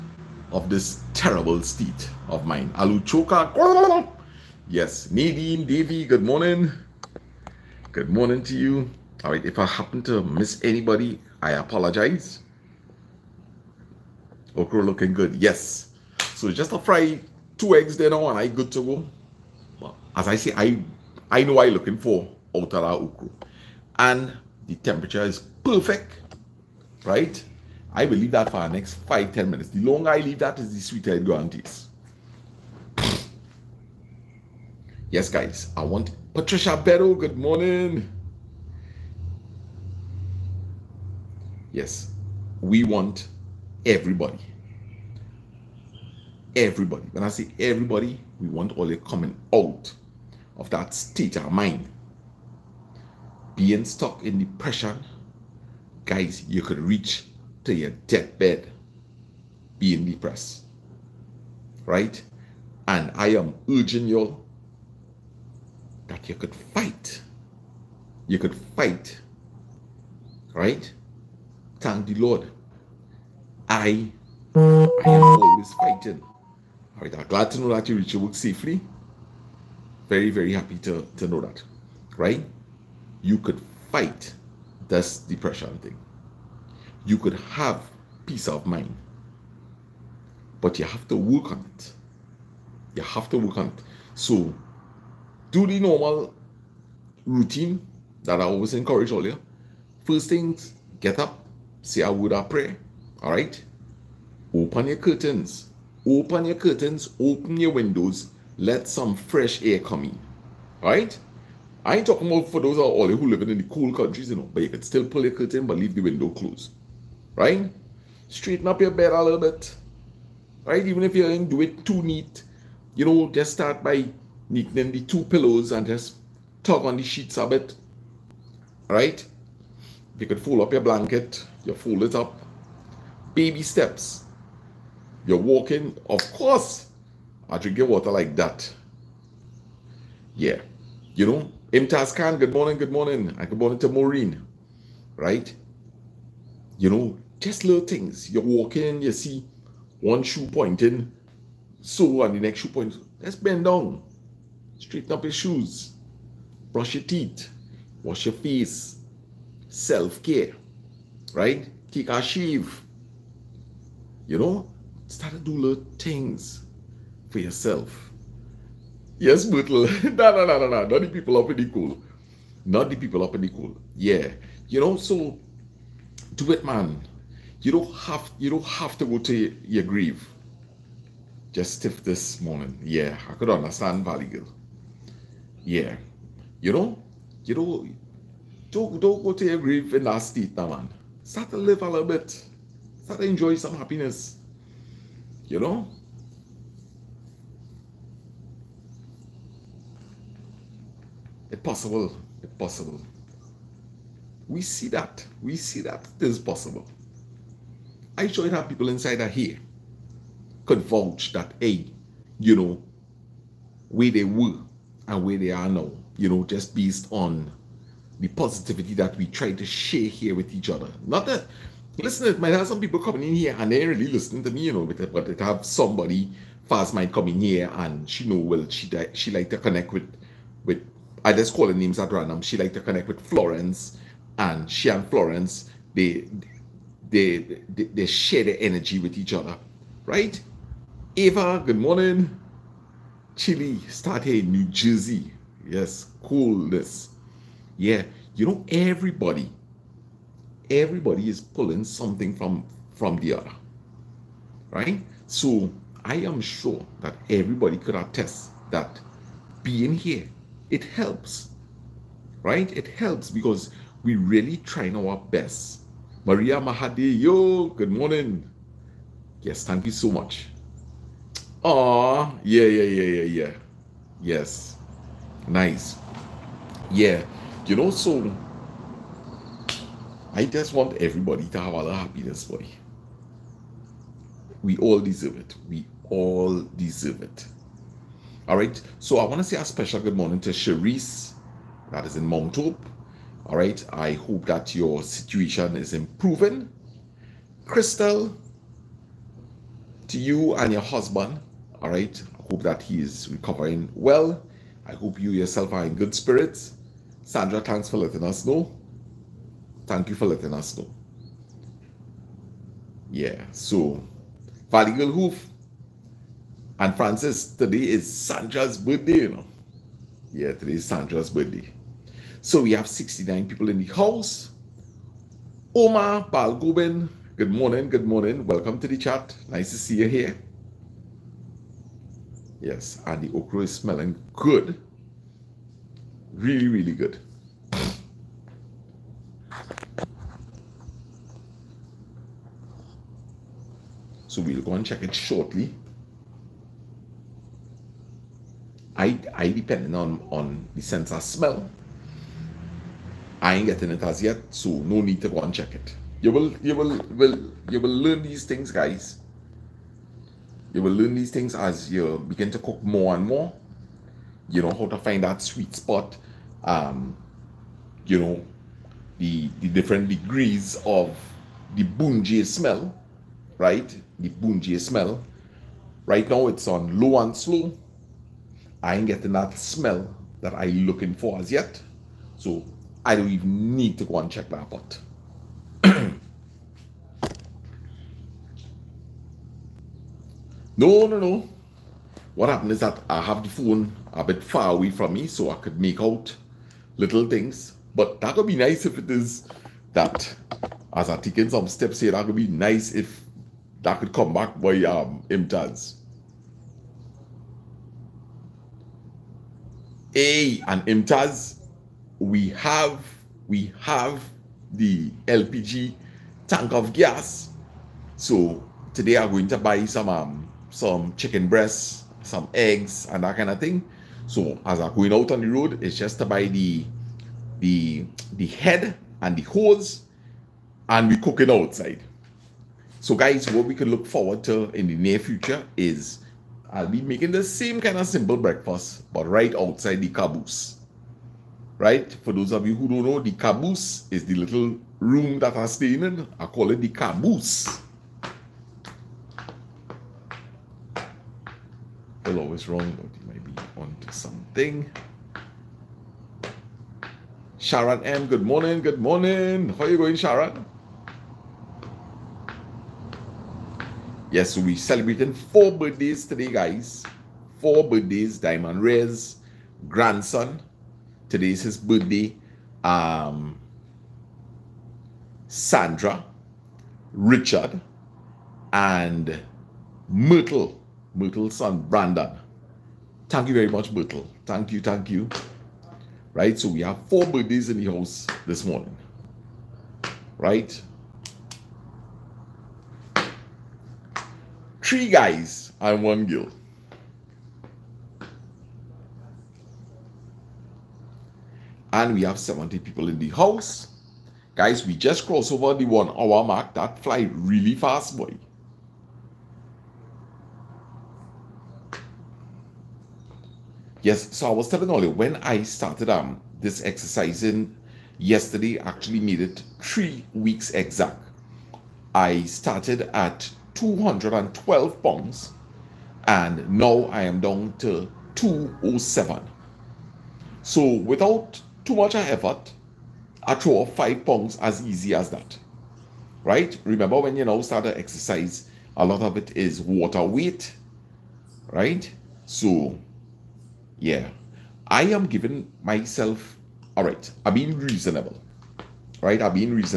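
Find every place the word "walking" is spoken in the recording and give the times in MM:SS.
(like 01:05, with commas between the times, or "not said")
02:15, 02:28.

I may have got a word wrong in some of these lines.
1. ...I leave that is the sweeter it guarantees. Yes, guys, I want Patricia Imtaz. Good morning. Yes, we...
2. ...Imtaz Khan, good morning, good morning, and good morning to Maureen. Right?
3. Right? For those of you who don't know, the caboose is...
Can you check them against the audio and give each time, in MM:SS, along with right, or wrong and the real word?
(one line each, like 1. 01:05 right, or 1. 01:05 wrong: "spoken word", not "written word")
1. 00:30 wrong: "Bedell", not "Imtaz"
2. 02:21 right
3. 07:21 right.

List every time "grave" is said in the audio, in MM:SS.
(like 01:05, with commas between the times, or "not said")
02:59, 03:09.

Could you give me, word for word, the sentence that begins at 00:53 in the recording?
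Being stuck in depression, guys, you could reach to your deathbed being depressed.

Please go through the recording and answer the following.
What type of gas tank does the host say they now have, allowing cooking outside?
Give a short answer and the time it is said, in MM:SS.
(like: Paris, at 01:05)
LPG, at 06:55.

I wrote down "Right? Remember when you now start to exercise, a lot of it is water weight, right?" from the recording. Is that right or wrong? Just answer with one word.
right.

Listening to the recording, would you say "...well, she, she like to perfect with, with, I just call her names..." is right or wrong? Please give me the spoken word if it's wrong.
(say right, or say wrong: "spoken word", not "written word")
wrong: "connect", not "perfect".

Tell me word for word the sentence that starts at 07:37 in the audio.
Sharon M, good morning, good morning.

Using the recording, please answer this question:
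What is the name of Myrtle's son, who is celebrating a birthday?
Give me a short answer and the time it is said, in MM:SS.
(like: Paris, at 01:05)
Brandon, at 08:01.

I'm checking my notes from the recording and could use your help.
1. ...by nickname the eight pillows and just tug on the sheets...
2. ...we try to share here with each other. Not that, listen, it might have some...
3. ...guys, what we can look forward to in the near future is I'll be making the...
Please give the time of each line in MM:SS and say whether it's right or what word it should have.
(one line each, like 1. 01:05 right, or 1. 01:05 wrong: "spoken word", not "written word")
1. 02:03 wrong: "two", not "eight"
2. 03:39 right
3. 07:13 right.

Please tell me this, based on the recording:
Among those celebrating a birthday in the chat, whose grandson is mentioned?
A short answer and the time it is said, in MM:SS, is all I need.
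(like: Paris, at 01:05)
Diamond Ray, at 07:48.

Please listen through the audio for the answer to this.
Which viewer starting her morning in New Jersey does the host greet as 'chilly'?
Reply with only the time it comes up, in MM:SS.
04:01.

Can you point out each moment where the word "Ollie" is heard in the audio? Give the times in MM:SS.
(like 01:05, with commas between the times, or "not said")
08:34.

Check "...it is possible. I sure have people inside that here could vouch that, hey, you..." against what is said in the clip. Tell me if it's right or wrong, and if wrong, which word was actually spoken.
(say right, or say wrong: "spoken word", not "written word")
right.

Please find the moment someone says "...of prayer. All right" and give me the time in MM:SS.
01:42.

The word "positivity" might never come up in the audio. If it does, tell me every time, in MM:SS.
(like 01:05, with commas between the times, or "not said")
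03:38.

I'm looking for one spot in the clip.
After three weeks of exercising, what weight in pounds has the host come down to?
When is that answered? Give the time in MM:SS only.
08:48.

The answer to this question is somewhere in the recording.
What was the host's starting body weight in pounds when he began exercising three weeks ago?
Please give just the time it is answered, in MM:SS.
08:43.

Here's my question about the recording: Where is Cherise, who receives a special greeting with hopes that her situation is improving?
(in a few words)
Mount Hope.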